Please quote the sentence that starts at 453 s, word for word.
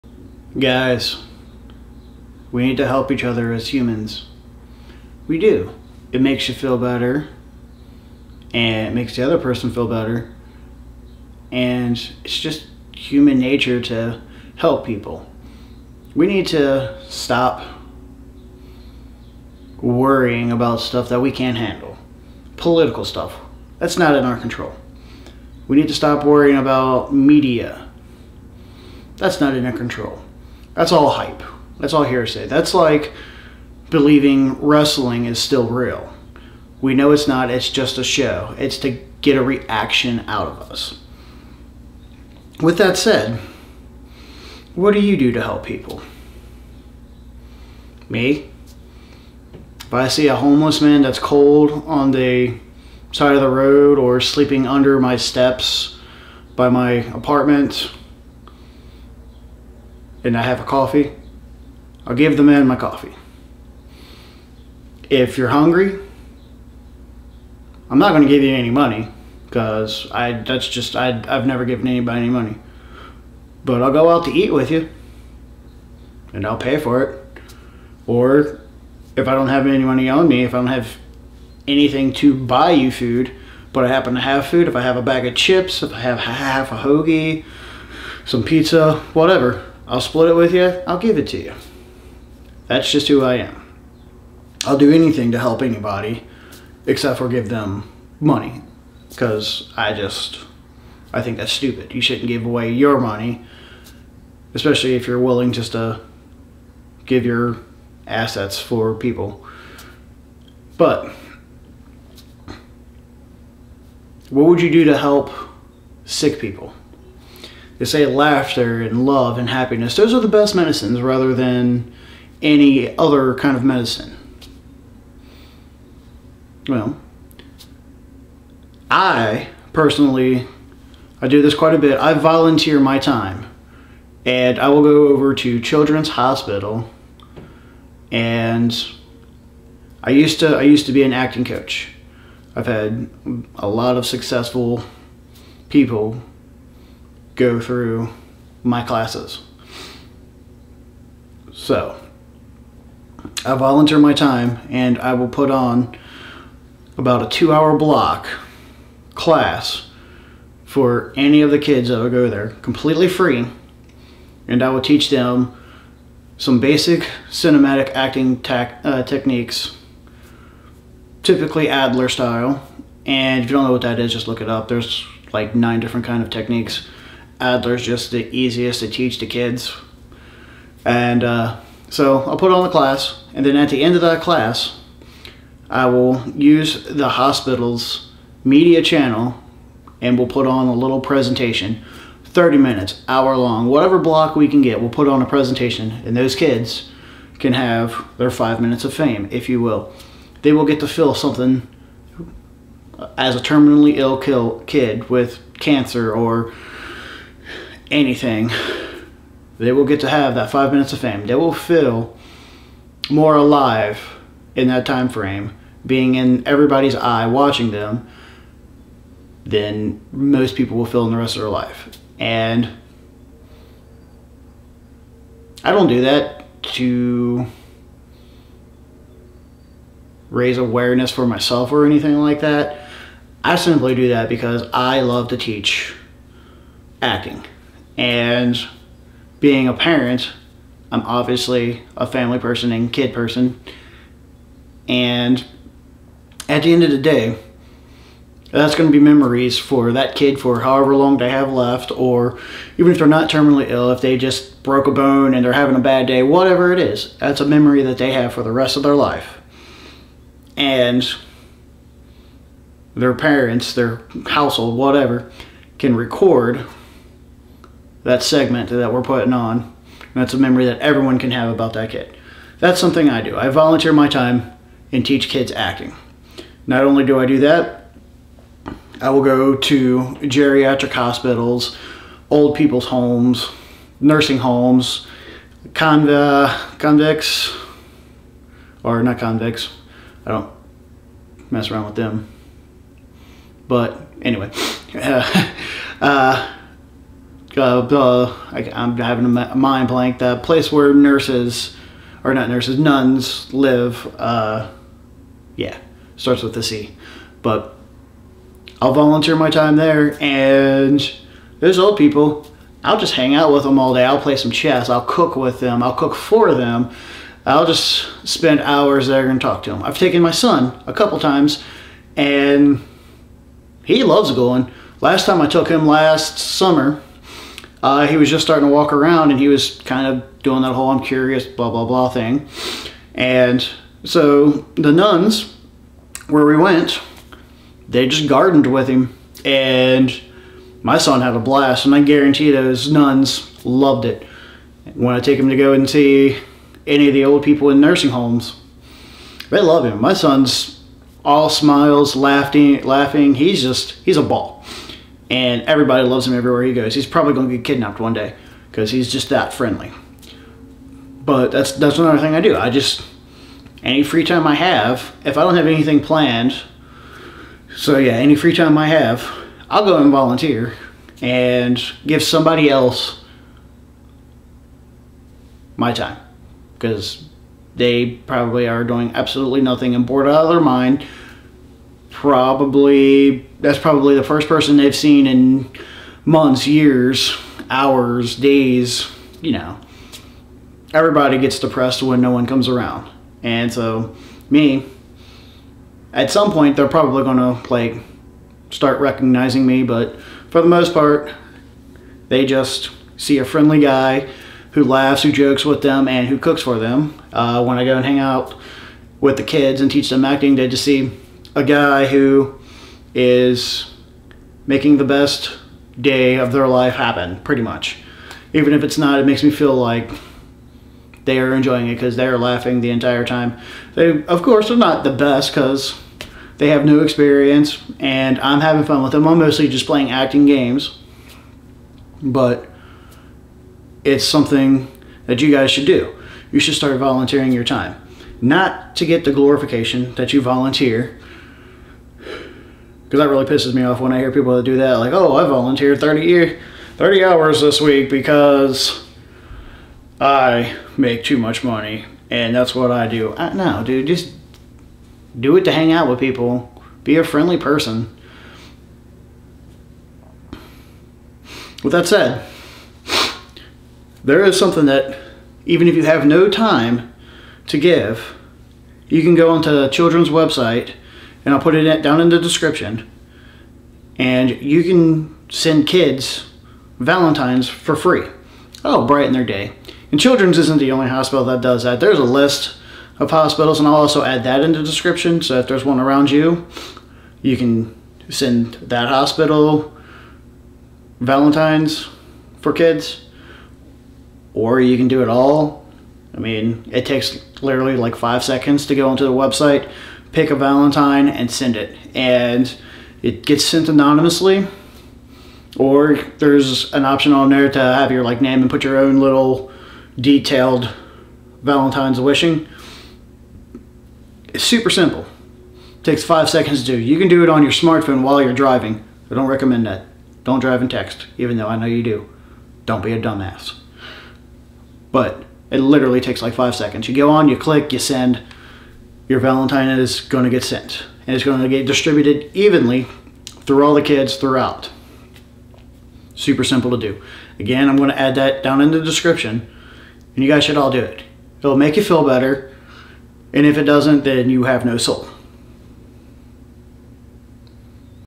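I, no, dude, just do it to hang out with people.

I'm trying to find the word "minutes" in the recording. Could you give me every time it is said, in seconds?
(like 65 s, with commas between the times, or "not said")
192 s, 198 s, 210 s.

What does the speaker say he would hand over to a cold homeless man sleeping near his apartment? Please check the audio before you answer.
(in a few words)
My coffee.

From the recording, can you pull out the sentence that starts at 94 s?
I'll do anything to help anybody except for give them money because I just, I think that's stupid.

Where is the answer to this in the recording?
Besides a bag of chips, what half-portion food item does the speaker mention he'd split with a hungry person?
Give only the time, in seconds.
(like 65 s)
86 s.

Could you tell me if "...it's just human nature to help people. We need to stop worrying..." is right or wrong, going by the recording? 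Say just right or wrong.
right.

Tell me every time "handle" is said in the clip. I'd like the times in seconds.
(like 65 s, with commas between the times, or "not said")
21 s.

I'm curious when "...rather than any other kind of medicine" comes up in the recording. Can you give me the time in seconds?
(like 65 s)
121 s.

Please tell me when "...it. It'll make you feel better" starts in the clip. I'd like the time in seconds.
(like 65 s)
541 s.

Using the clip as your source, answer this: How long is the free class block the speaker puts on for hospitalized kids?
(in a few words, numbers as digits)
2 hours.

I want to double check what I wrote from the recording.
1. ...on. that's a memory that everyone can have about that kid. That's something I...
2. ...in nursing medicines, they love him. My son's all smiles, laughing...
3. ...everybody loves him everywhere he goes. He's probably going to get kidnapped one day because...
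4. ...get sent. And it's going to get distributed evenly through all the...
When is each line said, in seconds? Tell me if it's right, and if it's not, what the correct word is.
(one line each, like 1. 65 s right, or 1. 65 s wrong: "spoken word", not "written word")
1. 269 s right
2. 347 s wrong: "homes", not "medicines"
3. 355 s right
4. 530 s right.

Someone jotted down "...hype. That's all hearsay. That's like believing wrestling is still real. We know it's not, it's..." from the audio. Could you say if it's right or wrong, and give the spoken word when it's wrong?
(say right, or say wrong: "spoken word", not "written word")
right.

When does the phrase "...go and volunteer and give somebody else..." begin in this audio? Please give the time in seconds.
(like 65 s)
369 s.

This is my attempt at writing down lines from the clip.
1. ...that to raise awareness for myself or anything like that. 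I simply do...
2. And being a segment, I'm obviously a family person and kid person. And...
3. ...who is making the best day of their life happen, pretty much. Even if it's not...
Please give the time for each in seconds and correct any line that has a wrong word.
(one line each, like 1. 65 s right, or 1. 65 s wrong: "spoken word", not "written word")
1. 226 s right
2. 238 s wrong: "parent", not "segment"
3. 412 s right.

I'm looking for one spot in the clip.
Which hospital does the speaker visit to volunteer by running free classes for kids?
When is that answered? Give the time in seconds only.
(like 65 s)
135 s.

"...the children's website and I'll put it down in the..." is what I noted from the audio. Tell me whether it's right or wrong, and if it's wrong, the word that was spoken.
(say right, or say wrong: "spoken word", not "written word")
right.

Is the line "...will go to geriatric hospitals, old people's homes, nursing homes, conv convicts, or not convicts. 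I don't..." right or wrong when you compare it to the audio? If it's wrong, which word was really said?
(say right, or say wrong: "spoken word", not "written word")
right.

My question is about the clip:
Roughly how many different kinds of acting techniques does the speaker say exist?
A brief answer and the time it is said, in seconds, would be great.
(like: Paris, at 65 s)
9, at 175 s.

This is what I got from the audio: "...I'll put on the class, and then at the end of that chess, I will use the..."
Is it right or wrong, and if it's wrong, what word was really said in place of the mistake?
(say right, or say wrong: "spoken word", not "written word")
wrong: "class", not "chess".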